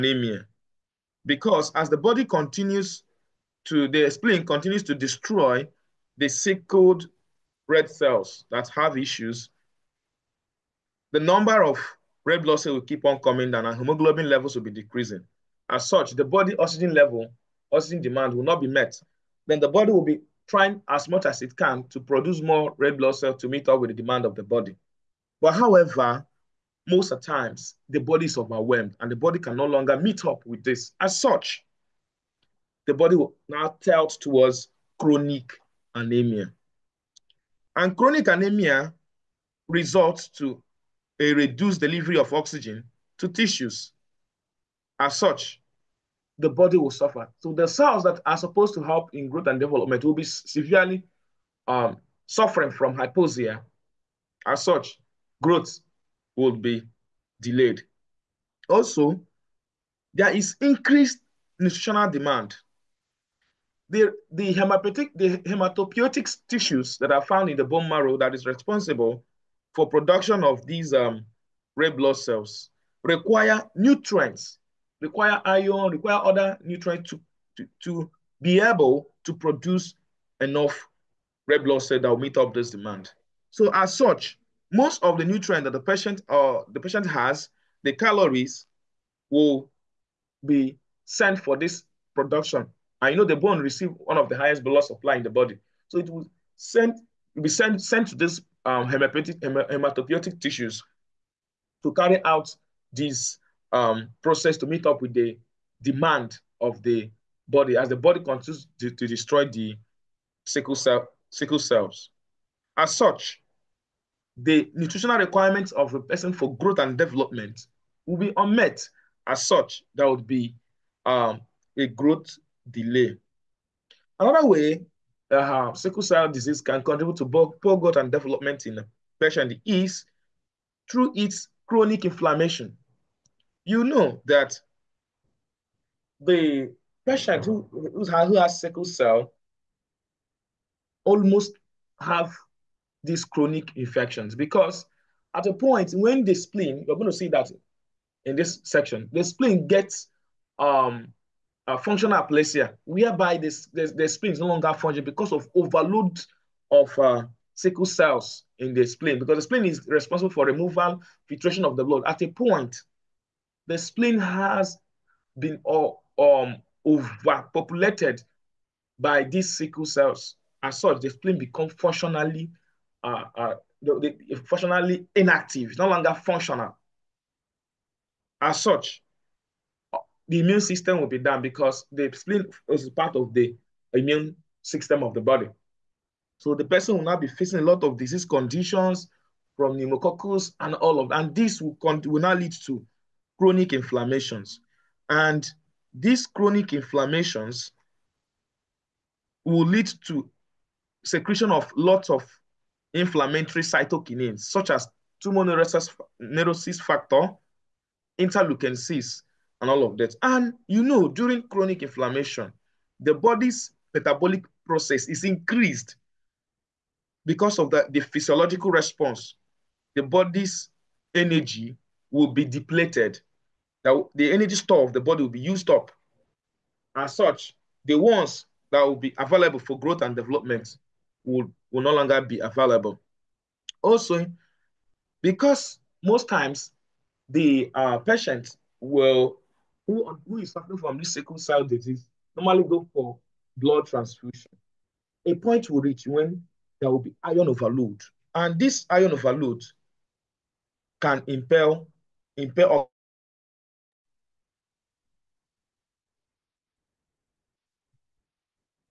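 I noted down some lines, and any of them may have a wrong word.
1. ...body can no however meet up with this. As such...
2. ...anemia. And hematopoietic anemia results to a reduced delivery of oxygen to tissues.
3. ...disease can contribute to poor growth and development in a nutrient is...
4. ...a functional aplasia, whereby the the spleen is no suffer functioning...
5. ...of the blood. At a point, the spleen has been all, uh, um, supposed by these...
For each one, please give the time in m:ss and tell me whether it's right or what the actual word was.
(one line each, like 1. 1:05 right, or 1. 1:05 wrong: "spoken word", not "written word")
1. 0:29 wrong: "longer", not "however"
2. 0:35 wrong: "chronic", not "hematopoietic"
3. 2:06 wrong: "patient", not "nutrient"
4. 2:31 wrong: "longer", not "suffer"
5. 2:41 wrong: "overpopulated", not "supposed".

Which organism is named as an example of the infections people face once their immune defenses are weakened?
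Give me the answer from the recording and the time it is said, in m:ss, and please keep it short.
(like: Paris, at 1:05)
Pneumococcus, at 3:09.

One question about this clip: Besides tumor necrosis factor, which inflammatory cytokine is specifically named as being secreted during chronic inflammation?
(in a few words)
Interleukin 6.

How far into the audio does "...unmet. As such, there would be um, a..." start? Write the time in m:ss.
1:58.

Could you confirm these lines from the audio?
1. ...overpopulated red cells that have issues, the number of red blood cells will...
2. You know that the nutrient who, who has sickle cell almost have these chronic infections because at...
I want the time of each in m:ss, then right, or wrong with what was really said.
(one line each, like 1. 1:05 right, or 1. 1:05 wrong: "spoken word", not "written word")
1. 0:06 wrong: "sickled", not "overpopulated"
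2. 2:13 wrong: "patient", not "nutrient".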